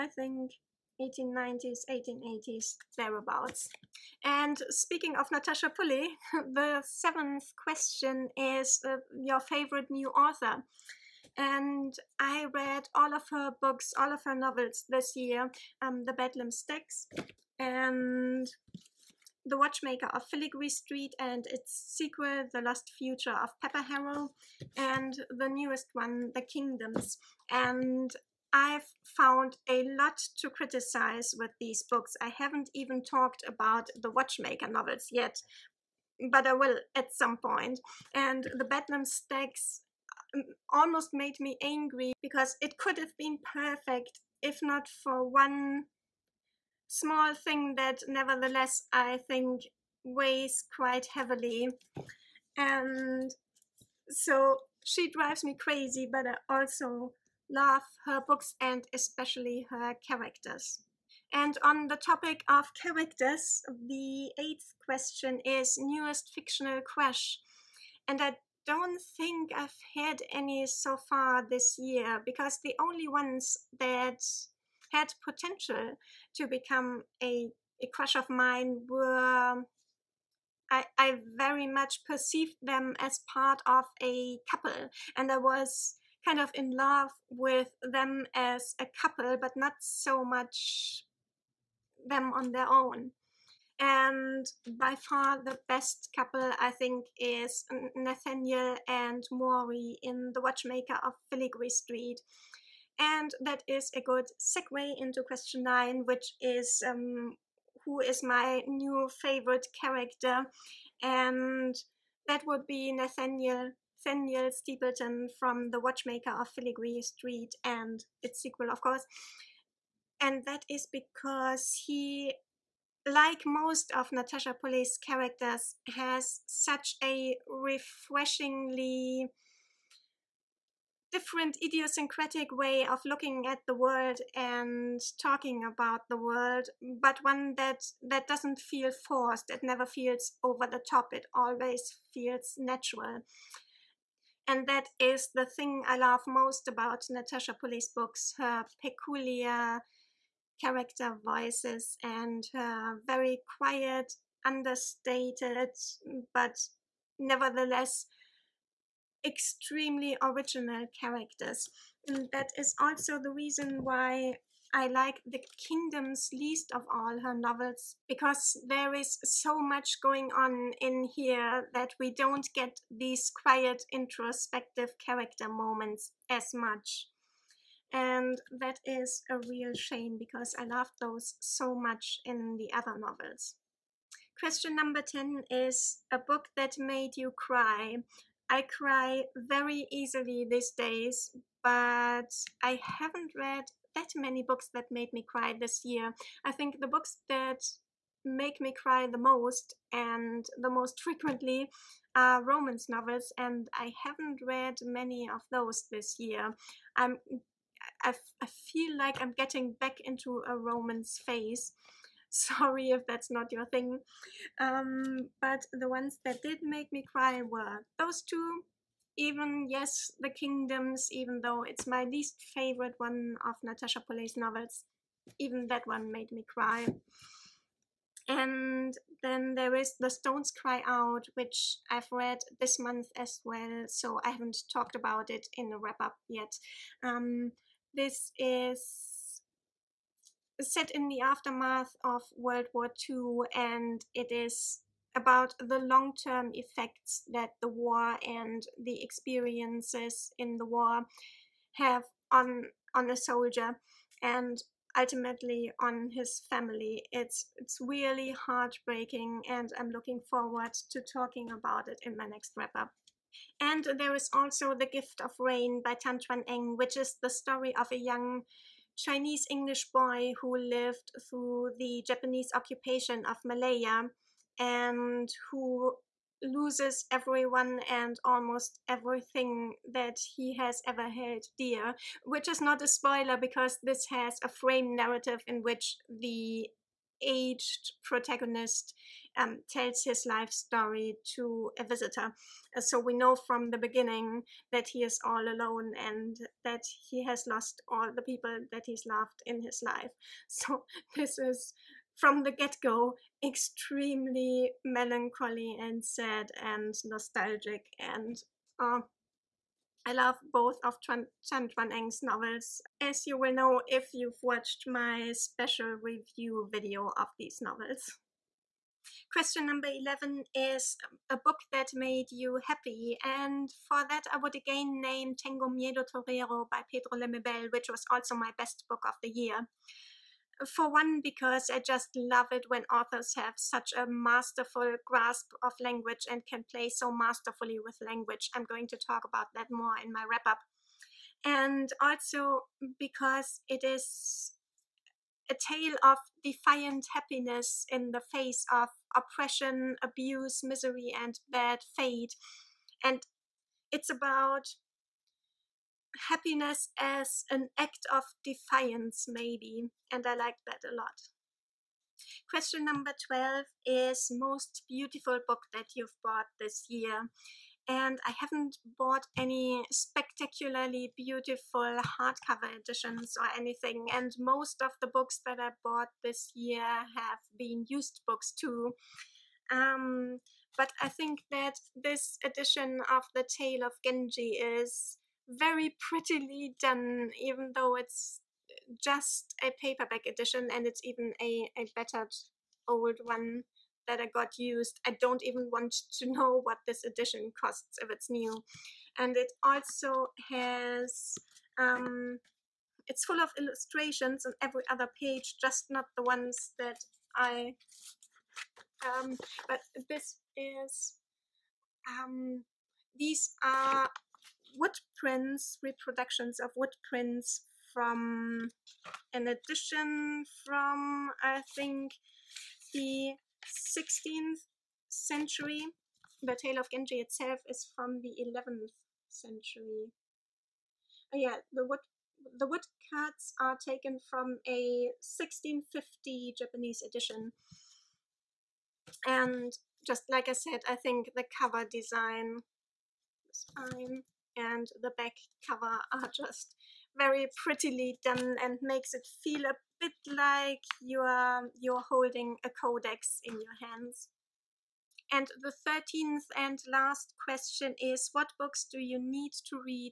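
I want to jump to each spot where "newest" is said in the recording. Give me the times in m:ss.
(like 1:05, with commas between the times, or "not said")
0:25, 1:05.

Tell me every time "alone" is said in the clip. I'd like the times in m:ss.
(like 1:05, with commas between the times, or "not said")
4:55.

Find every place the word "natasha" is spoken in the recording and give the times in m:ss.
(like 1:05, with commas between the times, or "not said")
0:05, 2:04, 2:27, 3:43.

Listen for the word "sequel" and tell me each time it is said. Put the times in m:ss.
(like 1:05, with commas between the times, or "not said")
0:21, 1:58.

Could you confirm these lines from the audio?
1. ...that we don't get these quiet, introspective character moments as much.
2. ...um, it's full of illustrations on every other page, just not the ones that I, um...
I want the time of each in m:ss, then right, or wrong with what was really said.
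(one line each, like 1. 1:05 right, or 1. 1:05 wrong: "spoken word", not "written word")
1. 2:51 right
2. 6:41 right.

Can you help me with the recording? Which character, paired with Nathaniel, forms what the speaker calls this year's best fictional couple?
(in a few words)
Mori.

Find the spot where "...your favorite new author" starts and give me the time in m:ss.
0:09.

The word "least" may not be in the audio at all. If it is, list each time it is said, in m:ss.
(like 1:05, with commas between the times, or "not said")
2:46, 3:42.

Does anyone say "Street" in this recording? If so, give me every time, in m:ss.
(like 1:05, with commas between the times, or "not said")
0:20, 1:41, 1:57.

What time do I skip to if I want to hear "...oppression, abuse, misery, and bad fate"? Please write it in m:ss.
5:49.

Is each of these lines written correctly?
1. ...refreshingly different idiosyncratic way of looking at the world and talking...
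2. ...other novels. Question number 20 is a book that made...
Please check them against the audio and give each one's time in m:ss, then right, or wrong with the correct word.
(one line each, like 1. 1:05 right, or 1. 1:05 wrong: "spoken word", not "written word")
1. 2:07 right
2. 3:02 wrong: "10", not "20".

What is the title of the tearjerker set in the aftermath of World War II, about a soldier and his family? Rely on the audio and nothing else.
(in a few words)
The Stones Cry Out.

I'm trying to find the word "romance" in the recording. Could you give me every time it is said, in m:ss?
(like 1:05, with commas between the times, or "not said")
3:22, 3:30.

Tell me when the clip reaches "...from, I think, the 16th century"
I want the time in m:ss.
7:00.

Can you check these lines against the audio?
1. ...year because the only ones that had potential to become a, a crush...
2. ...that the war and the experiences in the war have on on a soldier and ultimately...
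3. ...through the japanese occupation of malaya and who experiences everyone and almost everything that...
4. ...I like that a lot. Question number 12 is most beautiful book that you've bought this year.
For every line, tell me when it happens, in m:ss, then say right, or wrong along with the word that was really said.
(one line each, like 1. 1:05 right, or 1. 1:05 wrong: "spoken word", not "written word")
1. 1:11 right
2. 4:07 right
3. 4:31 wrong: "loses", not "experiences"
4. 6:00 right.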